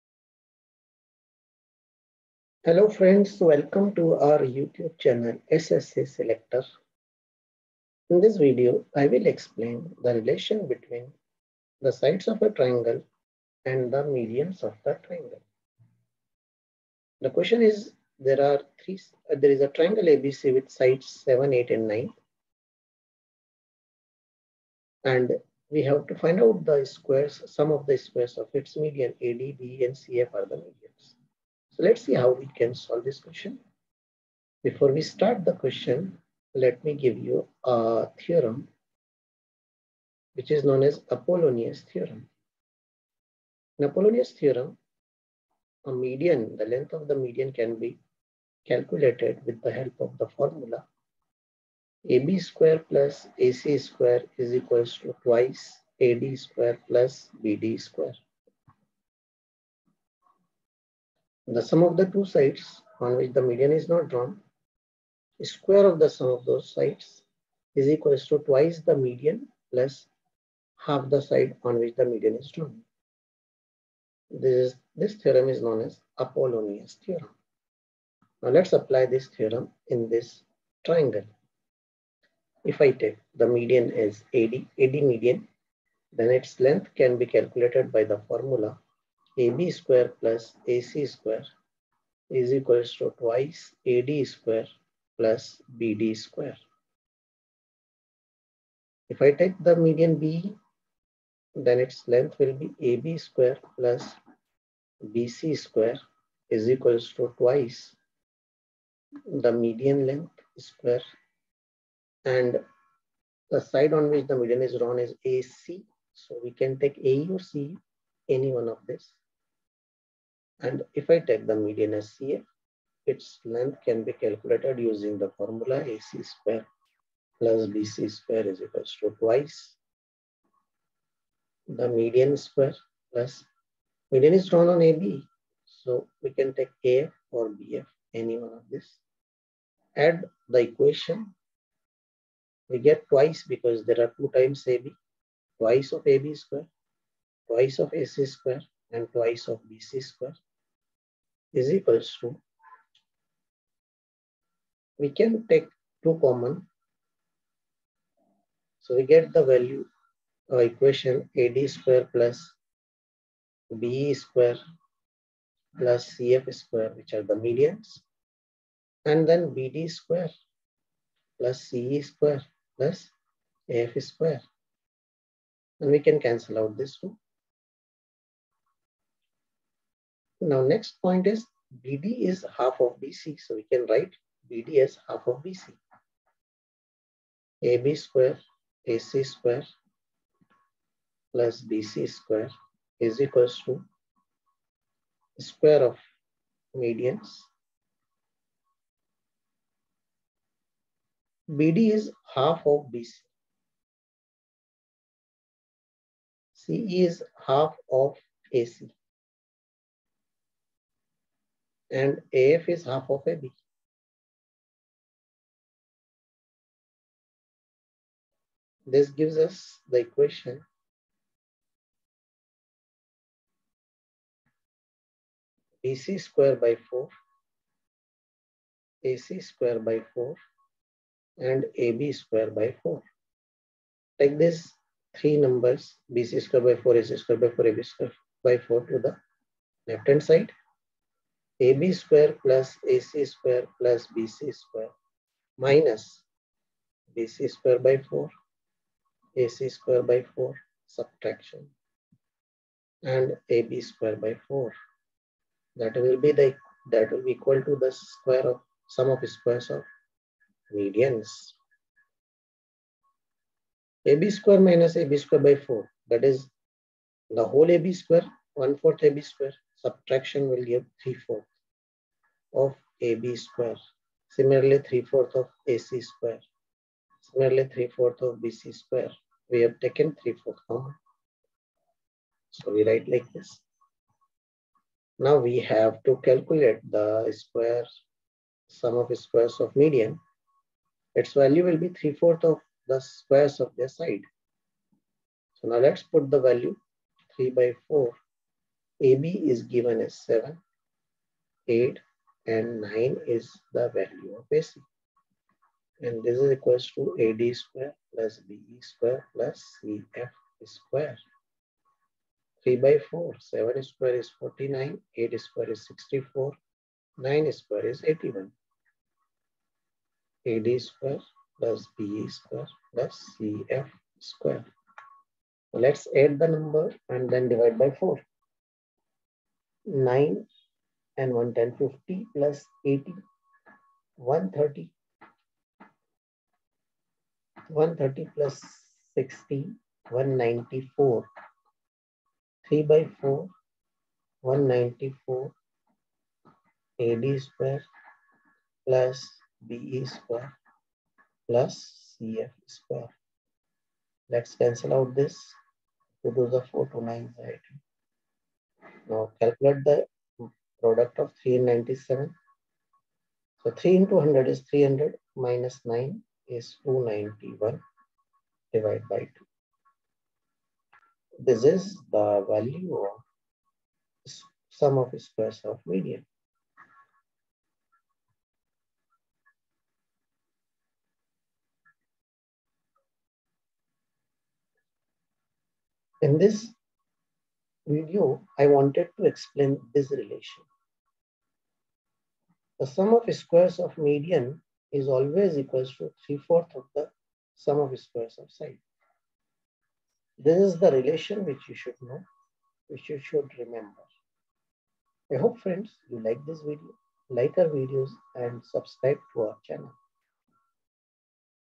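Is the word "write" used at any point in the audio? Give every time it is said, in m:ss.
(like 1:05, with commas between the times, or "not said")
3:03, 4:42.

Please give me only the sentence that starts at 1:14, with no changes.
This, is, this theorem is known as Apollonius theorem.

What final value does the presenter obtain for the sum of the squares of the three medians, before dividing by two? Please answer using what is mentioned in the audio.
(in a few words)
291.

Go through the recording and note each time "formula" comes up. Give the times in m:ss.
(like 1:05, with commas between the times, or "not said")
0:50, 1:28, 2:05.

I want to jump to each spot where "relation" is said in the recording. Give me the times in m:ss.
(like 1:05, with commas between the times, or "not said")
0:10, 6:30, 6:40.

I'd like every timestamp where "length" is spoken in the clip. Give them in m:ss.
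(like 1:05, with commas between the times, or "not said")
0:46, 1:26, 1:42, 1:50, 2:03.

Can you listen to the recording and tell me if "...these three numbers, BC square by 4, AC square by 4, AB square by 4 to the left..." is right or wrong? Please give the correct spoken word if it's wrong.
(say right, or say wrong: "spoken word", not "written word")
right.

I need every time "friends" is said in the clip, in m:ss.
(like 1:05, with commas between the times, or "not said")
0:02, 6:45.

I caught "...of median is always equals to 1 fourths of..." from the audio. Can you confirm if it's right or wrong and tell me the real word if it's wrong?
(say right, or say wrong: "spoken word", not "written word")
wrong: "3", not "1".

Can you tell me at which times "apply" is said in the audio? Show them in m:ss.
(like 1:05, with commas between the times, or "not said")
1:18.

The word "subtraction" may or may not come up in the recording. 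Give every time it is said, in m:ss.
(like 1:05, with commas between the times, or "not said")
4:10, 4:29.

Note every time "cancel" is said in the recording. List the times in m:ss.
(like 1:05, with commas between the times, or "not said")
2:56, 5:54.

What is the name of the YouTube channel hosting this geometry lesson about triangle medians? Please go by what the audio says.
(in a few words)
SSA Selector.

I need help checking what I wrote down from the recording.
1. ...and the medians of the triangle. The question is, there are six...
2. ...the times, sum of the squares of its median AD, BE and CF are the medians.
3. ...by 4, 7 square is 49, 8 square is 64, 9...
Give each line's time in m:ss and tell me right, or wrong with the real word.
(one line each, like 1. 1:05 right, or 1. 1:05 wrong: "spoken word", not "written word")
1. 0:13 wrong: "three", not "six"
2. 0:26 wrong: "squares", not "times"
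3. 5:12 right.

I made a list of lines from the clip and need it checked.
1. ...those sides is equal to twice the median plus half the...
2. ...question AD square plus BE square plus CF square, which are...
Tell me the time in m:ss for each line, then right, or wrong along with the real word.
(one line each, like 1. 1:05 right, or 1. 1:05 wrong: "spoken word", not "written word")
1. 1:06 right
2. 2:40 wrong: "equation", not "question".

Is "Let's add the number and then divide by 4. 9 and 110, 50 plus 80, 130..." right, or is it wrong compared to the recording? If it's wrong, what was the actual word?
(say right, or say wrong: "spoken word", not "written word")
right.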